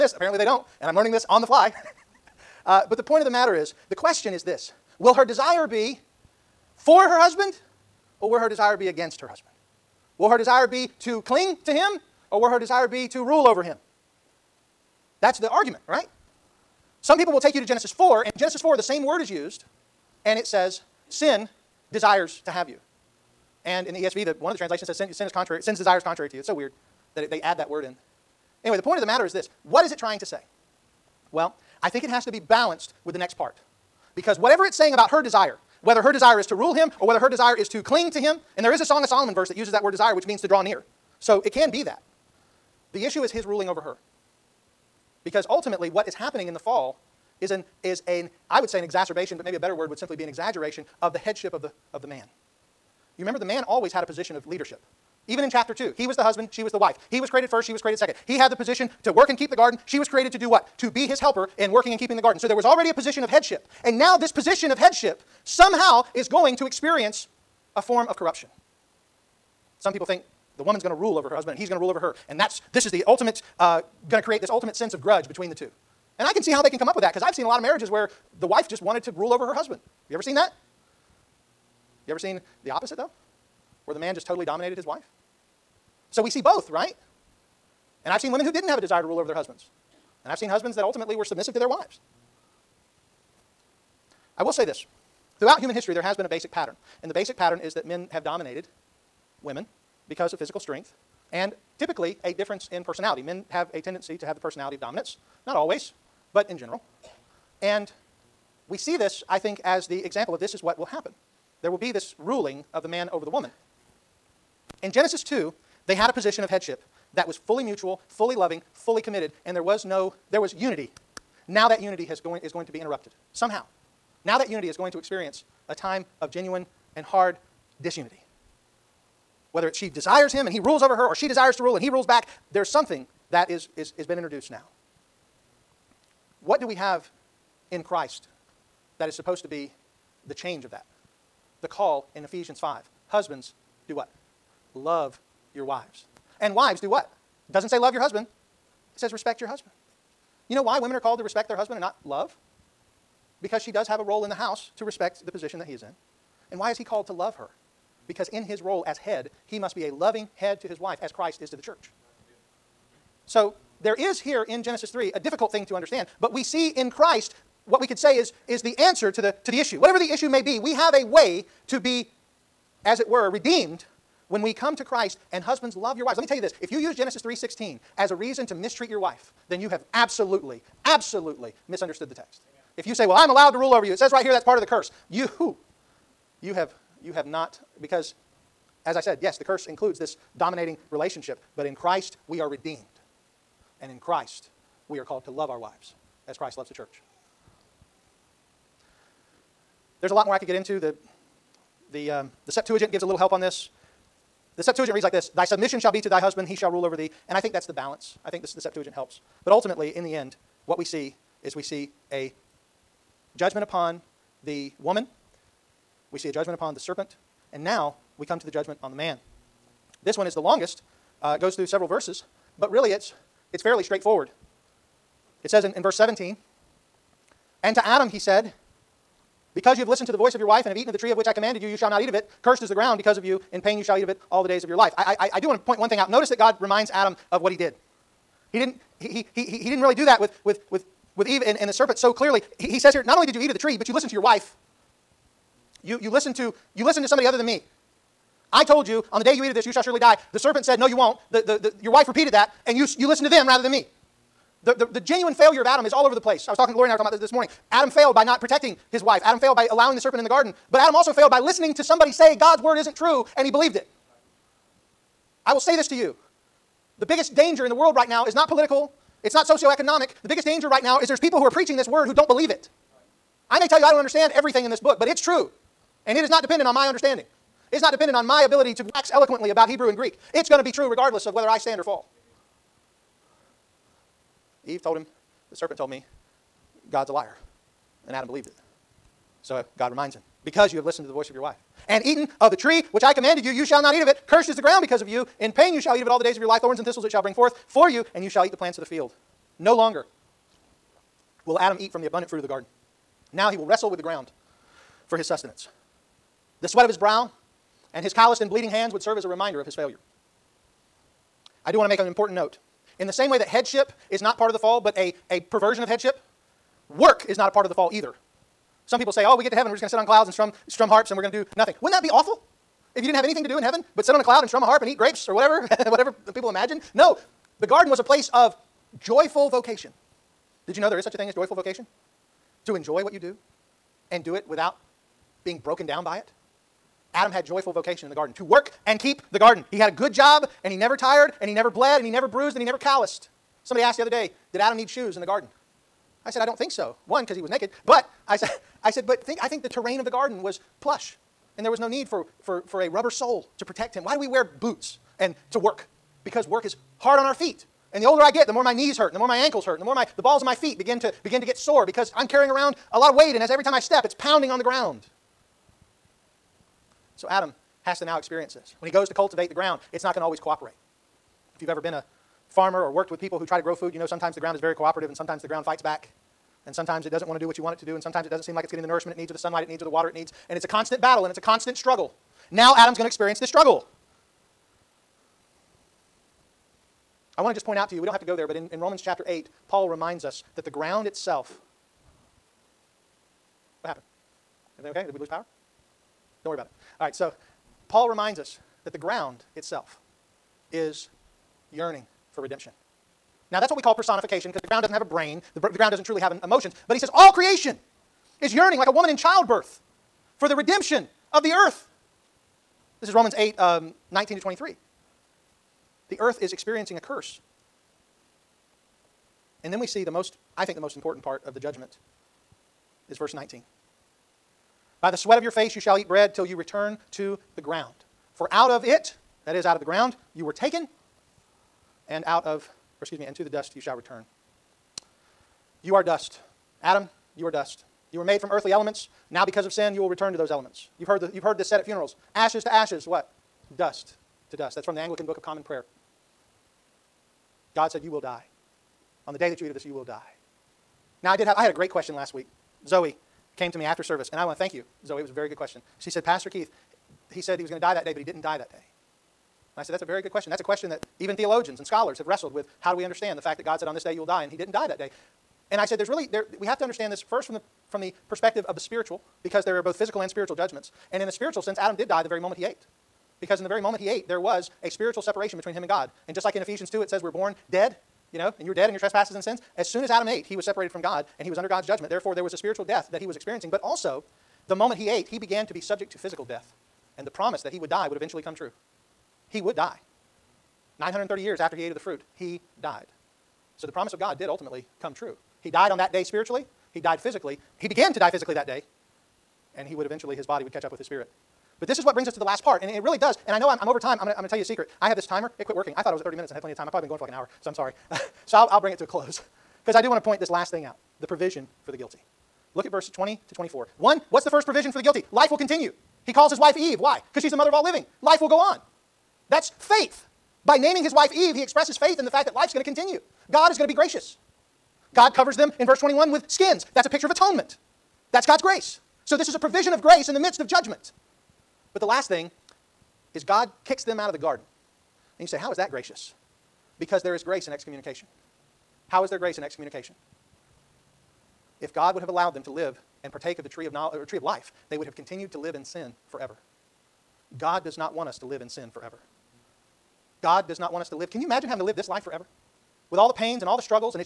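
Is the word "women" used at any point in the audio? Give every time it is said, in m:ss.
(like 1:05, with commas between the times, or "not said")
1:28, 1:39, 2:30.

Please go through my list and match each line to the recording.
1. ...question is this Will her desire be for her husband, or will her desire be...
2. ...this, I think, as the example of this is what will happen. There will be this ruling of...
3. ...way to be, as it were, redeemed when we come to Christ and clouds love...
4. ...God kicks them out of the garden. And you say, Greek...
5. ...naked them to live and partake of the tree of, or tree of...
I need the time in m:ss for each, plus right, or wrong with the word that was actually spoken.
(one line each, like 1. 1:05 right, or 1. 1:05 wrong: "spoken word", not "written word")
1. 0:03 right
2. 1:48 right
3. 2:51 wrong: "husbands", not "clouds"
4. 8:53 wrong: "How", not "Greek"
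5. 9:02 wrong: "allowed", not "naked".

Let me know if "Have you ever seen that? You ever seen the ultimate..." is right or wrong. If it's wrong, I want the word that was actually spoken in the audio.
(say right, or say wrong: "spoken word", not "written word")
wrong: "opposite", not "ultimate".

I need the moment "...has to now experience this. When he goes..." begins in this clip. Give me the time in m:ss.
6:07.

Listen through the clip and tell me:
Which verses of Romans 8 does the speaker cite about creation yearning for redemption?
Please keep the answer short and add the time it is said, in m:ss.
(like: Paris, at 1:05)
19 to 23, at 6:54.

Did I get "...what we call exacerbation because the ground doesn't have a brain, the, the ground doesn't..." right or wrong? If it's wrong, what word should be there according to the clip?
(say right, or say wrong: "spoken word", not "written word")
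wrong: "personification", not "exacerbation".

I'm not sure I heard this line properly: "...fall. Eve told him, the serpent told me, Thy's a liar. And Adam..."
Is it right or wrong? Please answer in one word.
wrong.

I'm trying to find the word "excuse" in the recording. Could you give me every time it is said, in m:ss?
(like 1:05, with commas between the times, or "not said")
7:13.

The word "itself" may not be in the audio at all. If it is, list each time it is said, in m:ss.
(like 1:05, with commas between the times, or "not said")
6:31, 6:39.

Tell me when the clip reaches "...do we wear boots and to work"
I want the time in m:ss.
5:54.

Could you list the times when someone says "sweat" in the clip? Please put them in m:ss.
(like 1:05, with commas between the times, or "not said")
5:06, 7:05.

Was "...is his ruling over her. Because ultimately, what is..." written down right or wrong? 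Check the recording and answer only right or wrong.
right.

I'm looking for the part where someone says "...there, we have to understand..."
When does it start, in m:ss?
7:46.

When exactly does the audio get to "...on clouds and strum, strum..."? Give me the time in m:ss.
5:19.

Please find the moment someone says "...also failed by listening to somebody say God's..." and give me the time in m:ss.
4:20.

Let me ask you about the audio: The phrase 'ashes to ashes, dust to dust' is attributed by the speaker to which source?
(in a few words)
Anglican Book of Common Prayer.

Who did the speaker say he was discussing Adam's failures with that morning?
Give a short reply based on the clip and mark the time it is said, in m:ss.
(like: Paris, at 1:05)
Lori, at 4:16.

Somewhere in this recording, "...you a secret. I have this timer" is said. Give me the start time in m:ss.
8:24.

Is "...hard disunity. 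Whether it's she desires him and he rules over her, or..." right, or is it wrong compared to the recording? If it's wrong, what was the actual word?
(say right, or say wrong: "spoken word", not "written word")
right.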